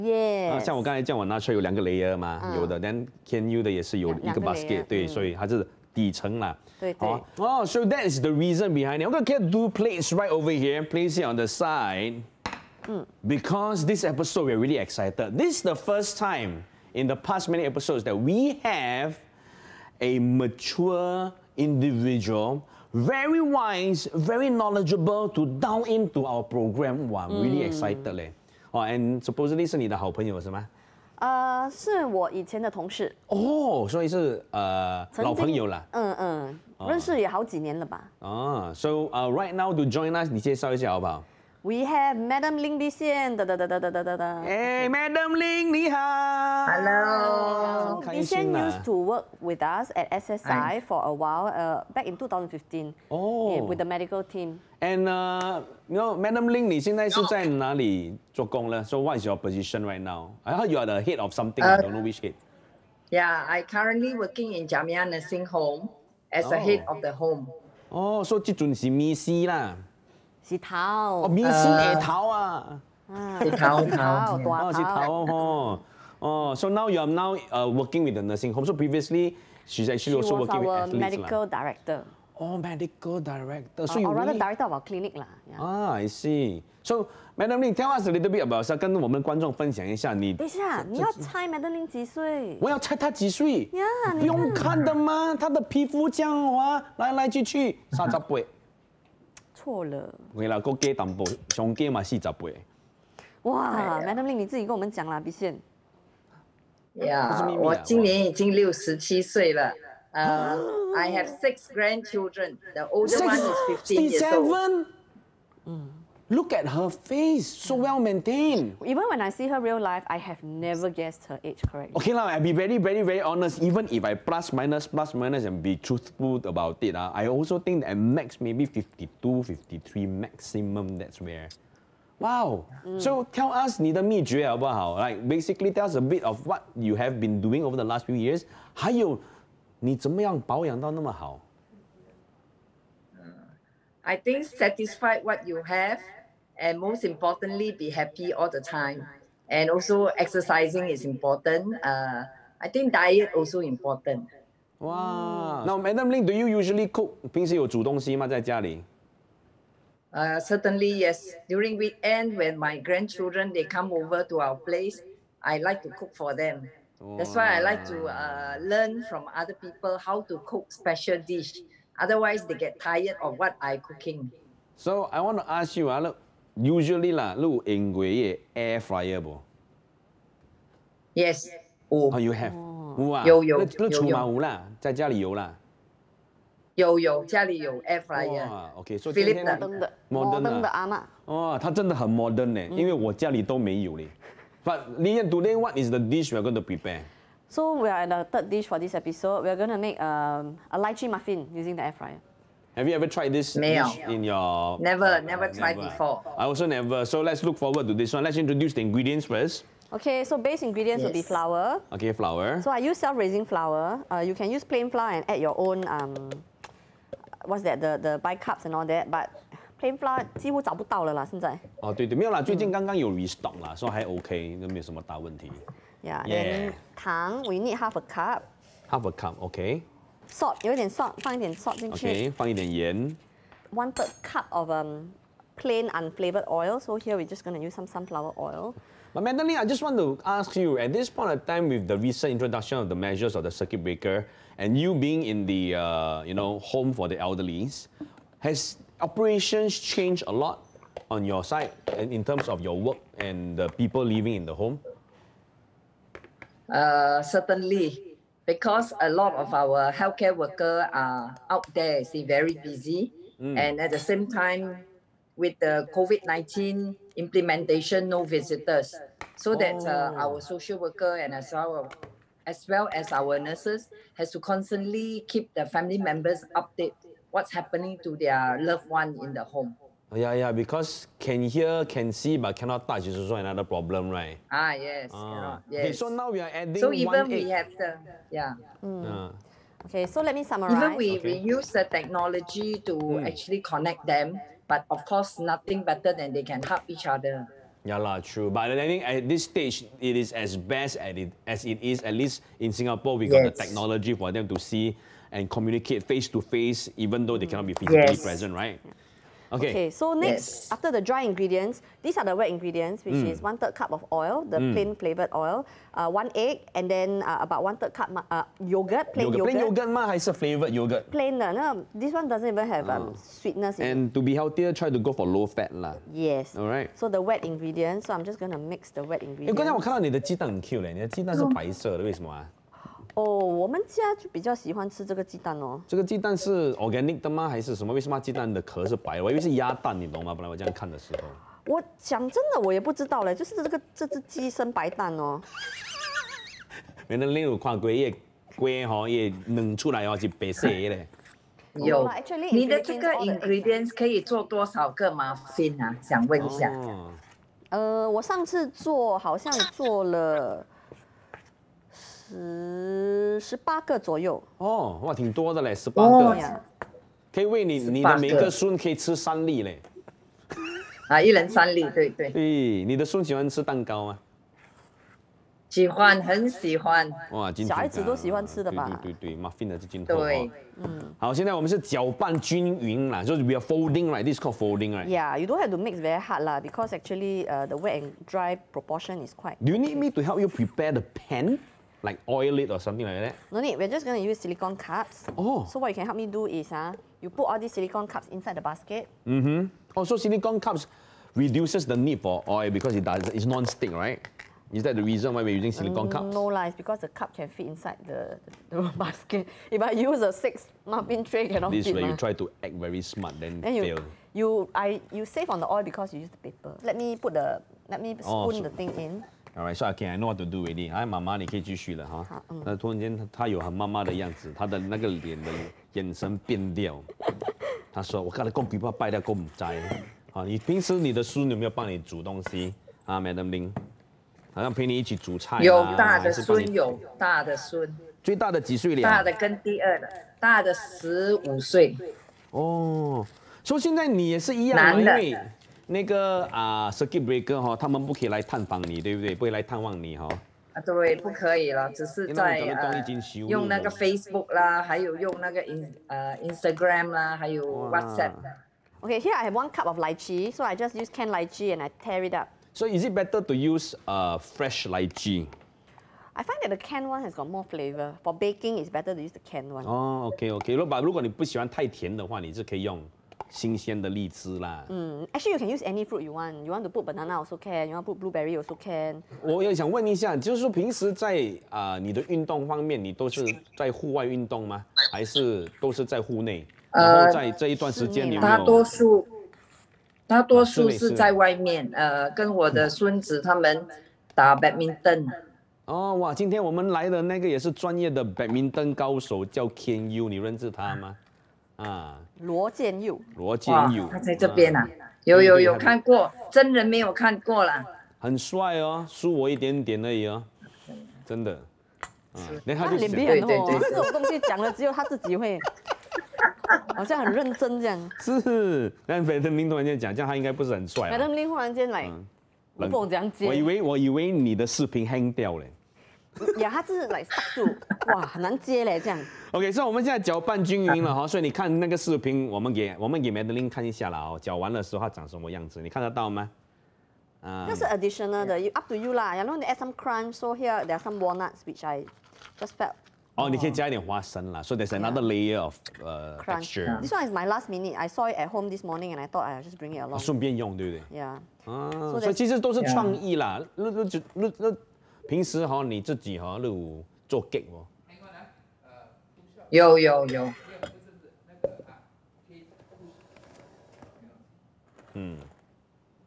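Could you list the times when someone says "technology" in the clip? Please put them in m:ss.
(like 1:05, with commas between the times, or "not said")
4:51, 5:03.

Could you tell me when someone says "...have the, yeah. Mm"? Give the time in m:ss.
4:47.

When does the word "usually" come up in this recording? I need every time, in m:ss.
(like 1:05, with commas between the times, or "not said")
2:36, 2:56.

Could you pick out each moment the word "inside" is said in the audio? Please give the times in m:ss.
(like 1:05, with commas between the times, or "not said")
6:38, 6:47.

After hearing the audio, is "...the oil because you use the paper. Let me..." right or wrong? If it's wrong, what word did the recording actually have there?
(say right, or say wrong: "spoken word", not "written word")
right.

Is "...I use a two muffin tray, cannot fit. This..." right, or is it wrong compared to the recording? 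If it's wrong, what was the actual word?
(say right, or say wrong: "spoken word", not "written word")
wrong: "six", not "two".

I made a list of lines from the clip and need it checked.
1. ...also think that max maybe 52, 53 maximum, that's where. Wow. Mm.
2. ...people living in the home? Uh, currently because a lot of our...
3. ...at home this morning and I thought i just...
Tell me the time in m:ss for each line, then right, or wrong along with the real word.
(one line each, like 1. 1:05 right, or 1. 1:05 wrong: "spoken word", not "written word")
1. 2:07 right
2. 4:13 wrong: "certainly", not "currently"
3. 9:08 right.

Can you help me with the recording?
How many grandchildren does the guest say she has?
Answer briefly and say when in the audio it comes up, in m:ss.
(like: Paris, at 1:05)
6, at 1:51.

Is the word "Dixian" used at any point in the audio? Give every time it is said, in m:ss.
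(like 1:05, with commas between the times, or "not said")
0:42, 0:48.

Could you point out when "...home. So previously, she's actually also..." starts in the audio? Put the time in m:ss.
1:18.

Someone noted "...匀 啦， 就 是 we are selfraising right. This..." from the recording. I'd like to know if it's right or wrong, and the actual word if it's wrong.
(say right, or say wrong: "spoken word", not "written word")
wrong: "folding", not "selfraising".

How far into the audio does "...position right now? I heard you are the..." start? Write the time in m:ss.
0:59.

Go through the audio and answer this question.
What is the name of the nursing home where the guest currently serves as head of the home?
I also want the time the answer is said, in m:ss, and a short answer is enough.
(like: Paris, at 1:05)
Jamia Nursing Home, at 1:04.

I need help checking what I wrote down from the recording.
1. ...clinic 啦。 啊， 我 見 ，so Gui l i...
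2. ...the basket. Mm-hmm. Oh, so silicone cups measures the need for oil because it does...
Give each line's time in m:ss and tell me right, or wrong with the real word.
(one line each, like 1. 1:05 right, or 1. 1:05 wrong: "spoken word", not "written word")
1. 1:24 wrong: "Madam", not "Gui"
2. 6:38 wrong: "reduces", not "measures".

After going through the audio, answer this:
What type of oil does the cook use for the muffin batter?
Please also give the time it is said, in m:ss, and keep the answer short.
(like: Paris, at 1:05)
Sunflower oil, at 3:57.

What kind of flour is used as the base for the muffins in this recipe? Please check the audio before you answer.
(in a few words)
Self-raising flour.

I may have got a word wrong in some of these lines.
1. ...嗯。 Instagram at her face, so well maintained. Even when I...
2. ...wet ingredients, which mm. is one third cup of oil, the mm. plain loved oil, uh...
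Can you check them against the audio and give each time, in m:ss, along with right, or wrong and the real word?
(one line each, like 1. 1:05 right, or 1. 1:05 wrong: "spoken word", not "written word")
1. 1:55 wrong: "Look", not "Instagram"
2. 5:12 wrong: "flavored", not "loved".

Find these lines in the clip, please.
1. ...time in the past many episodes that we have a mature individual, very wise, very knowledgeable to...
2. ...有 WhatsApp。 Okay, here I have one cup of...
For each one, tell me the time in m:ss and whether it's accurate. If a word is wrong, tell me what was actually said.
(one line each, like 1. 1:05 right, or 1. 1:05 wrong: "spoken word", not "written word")
1. 0:16 right
2. 7:37 right.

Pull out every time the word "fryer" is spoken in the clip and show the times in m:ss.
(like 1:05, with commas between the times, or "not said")
2:58, 3:08, 3:21.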